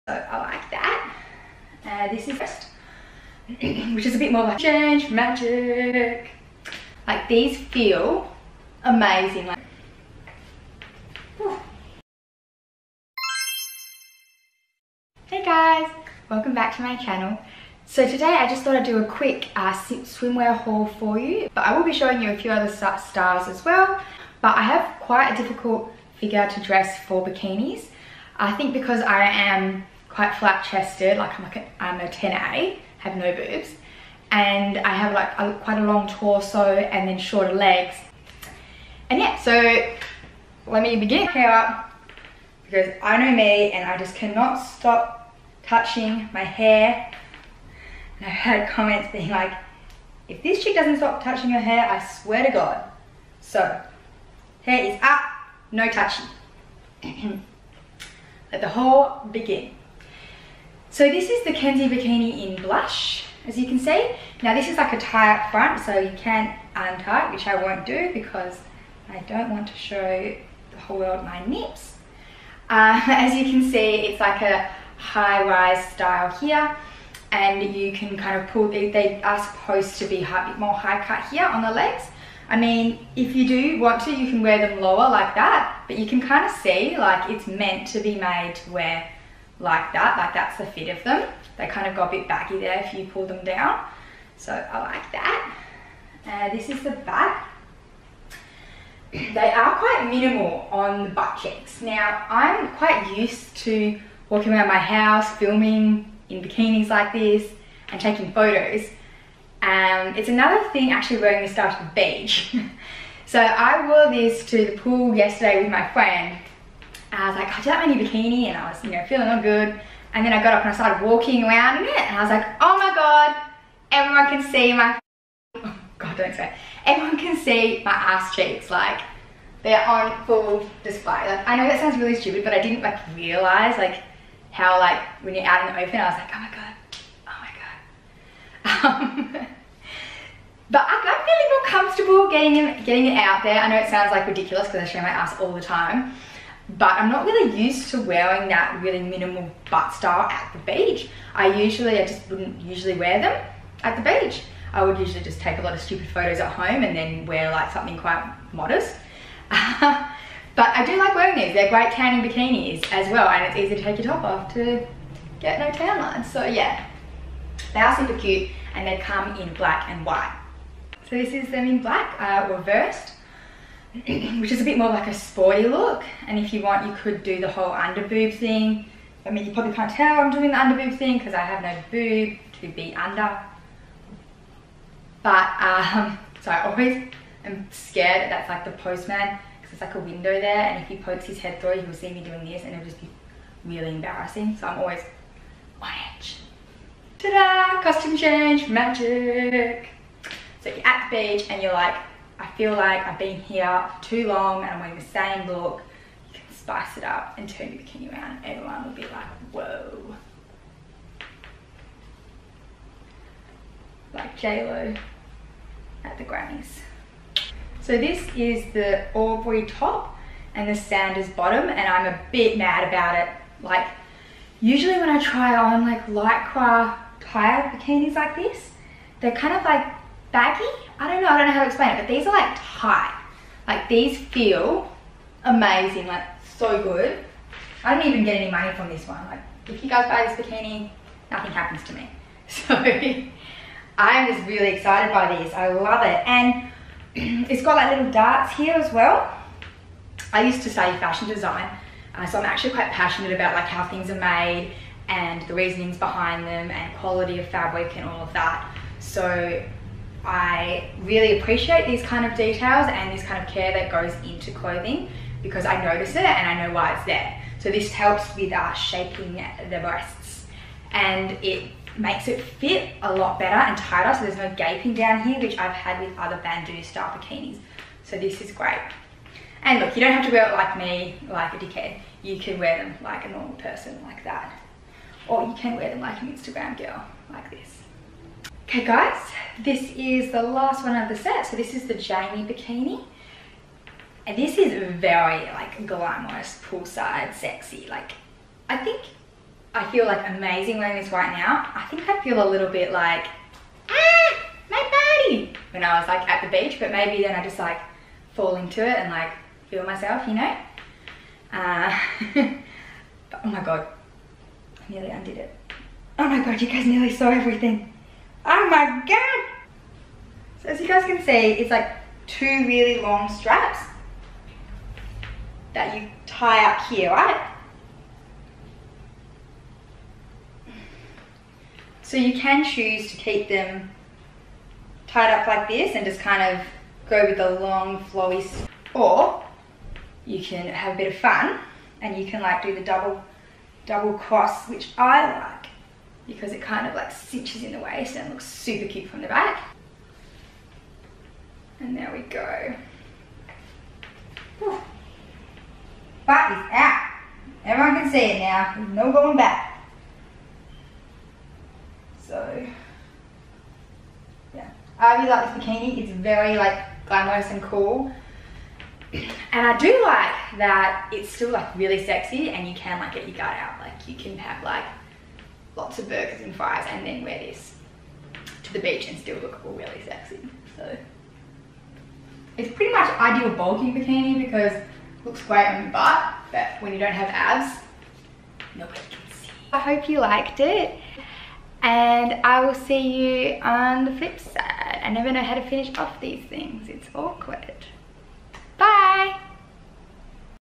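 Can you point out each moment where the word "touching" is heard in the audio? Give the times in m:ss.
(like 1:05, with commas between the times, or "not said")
0:45, 0:51, 0:55.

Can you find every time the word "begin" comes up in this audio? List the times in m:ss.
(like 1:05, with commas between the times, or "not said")
0:40, 0:59.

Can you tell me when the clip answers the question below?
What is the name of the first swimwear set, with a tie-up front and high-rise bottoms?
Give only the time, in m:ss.
1:01.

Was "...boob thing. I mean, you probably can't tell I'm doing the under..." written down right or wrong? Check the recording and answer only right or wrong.
right.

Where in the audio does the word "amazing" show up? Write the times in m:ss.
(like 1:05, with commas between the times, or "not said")
0:08, 3:55, 5:00.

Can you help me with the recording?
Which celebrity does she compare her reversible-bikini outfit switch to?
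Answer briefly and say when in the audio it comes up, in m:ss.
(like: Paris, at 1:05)
JLo, at 3:34.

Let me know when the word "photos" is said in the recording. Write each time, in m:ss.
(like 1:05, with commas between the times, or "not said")
1:48, 2:36.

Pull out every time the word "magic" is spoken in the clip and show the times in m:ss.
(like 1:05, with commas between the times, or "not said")
0:05, 3:18.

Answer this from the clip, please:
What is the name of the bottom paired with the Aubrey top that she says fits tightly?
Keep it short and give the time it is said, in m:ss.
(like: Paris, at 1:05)
Sanders, at 3:40.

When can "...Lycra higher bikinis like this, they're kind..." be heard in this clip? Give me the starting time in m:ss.
3:46.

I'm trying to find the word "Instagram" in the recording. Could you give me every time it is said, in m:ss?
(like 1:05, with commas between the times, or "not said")
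4:46.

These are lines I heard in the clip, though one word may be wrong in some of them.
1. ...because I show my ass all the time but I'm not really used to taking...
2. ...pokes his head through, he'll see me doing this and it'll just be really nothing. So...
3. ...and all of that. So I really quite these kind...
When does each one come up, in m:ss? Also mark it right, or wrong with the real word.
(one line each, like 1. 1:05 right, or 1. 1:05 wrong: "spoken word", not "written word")
1. 2:24 wrong: "wearing", not "taking"
2. 3:10 wrong: "embarrassing", not "nothing"
3. 4:17 wrong: "appreciate", not "quite".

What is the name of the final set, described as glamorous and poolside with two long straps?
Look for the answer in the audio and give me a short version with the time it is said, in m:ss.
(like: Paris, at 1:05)
Jamie bikini, at 4:51.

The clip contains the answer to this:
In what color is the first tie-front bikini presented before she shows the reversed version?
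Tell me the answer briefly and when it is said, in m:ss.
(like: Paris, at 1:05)
blush, at 1:02.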